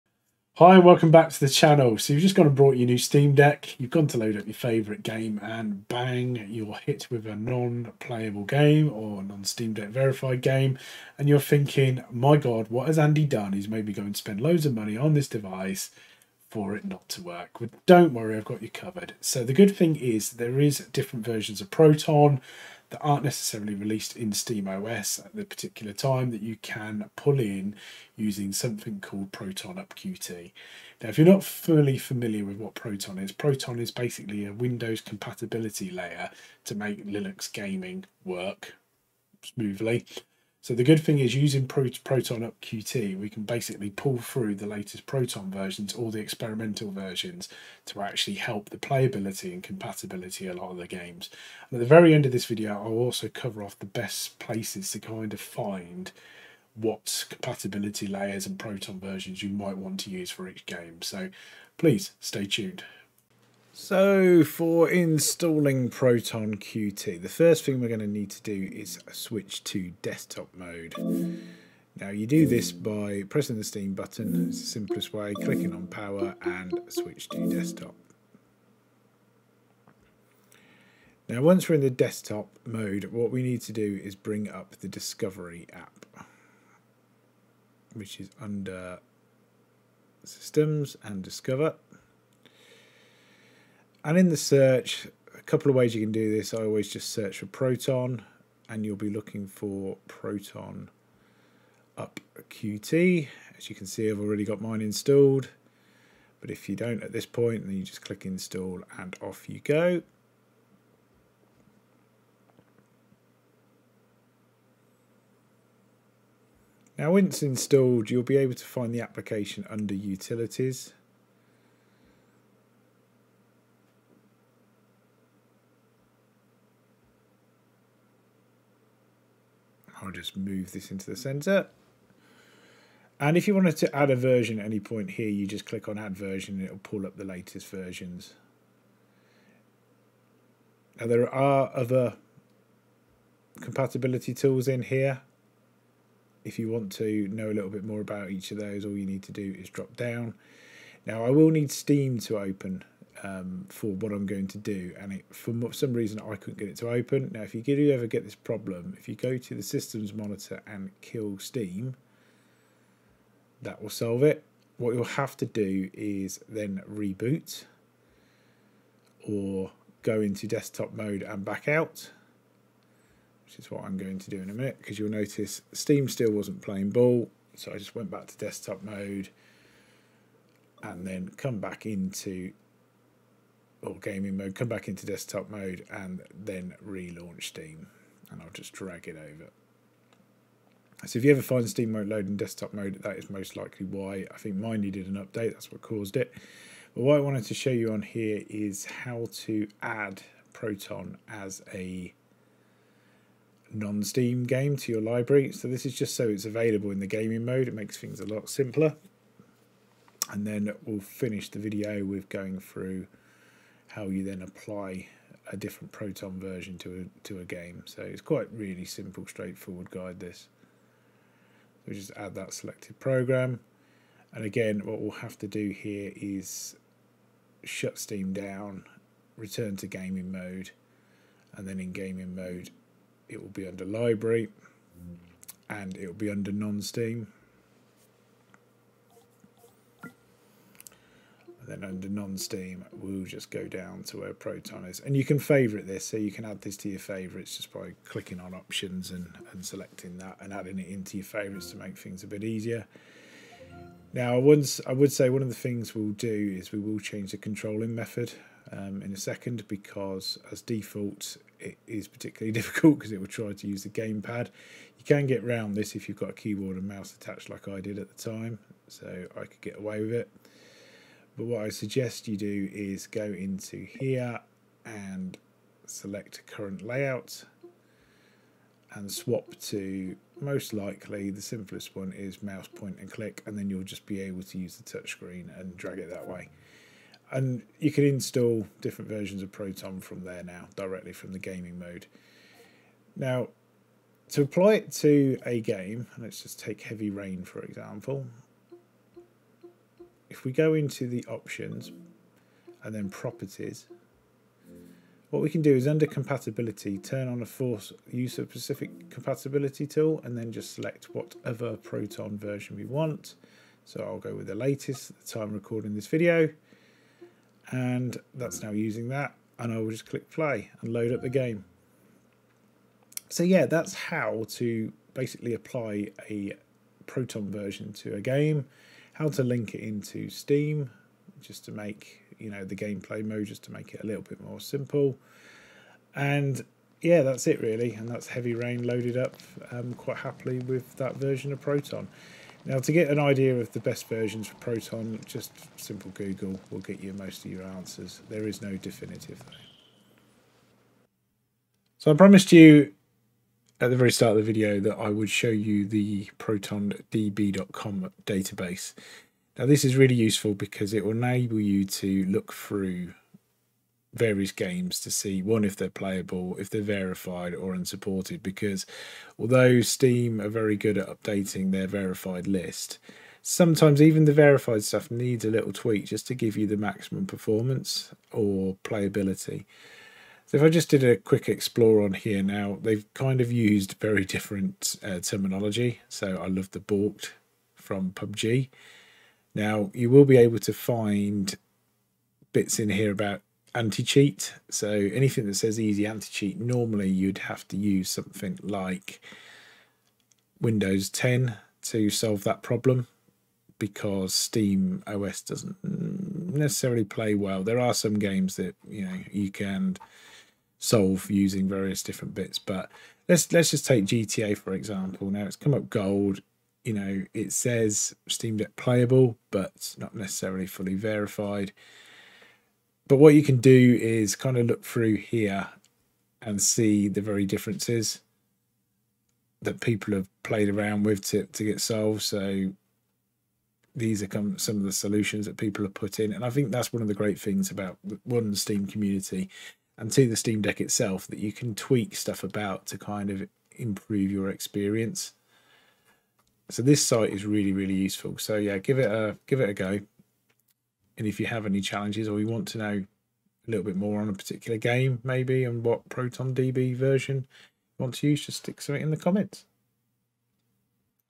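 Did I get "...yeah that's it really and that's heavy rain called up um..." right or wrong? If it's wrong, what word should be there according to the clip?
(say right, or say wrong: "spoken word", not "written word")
wrong: "loaded", not "called".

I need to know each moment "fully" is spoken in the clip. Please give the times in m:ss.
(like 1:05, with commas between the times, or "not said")
0:31, 7:00.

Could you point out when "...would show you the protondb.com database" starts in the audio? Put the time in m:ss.
5:55.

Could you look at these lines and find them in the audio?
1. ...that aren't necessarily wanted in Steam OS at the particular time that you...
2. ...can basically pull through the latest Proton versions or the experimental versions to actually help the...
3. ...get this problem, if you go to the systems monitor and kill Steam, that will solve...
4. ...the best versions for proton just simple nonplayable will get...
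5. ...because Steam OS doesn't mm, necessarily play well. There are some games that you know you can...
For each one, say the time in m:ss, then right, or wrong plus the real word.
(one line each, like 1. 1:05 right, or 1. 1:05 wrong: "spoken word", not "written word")
1. 0:22 wrong: "released", not "wanted"
2. 0:43 right
3. 2:38 right
4. 5:43 wrong: "google", not "nonplayable"
5. 6:43 right.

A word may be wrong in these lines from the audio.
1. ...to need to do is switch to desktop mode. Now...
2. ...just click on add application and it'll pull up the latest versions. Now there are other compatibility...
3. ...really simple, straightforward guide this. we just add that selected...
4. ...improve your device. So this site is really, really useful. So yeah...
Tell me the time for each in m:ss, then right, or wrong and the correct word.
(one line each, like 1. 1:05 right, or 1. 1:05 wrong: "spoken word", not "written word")
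1. 1:08 right
2. 2:15 wrong: "version", not "application"
3. 3:38 right
4. 7:23 wrong: "experience", not "device".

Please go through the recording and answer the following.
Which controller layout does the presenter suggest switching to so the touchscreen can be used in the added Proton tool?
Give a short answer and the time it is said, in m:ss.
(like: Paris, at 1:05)
Mouse point and click, at 4:42.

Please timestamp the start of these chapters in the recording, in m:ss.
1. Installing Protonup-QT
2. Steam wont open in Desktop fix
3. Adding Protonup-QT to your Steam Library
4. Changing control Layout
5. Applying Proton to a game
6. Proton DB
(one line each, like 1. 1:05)
1. 1:03
2. 2:35
3. 3:22
4. 4:31
5. 4:58
6. 5:50.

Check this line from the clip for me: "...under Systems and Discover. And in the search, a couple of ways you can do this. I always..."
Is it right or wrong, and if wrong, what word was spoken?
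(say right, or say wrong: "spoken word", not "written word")
right.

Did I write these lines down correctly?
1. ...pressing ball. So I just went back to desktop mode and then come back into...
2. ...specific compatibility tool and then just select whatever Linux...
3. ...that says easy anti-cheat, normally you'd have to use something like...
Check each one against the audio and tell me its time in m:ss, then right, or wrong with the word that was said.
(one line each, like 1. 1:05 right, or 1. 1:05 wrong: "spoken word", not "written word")
1. 2:56 wrong: "playing", not "pressing"
2. 5:08 wrong: "Proton", not "Linux"
3. 6:35 right.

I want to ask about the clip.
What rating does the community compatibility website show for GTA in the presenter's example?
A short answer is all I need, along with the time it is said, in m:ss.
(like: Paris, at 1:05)
Gold, at 6:55.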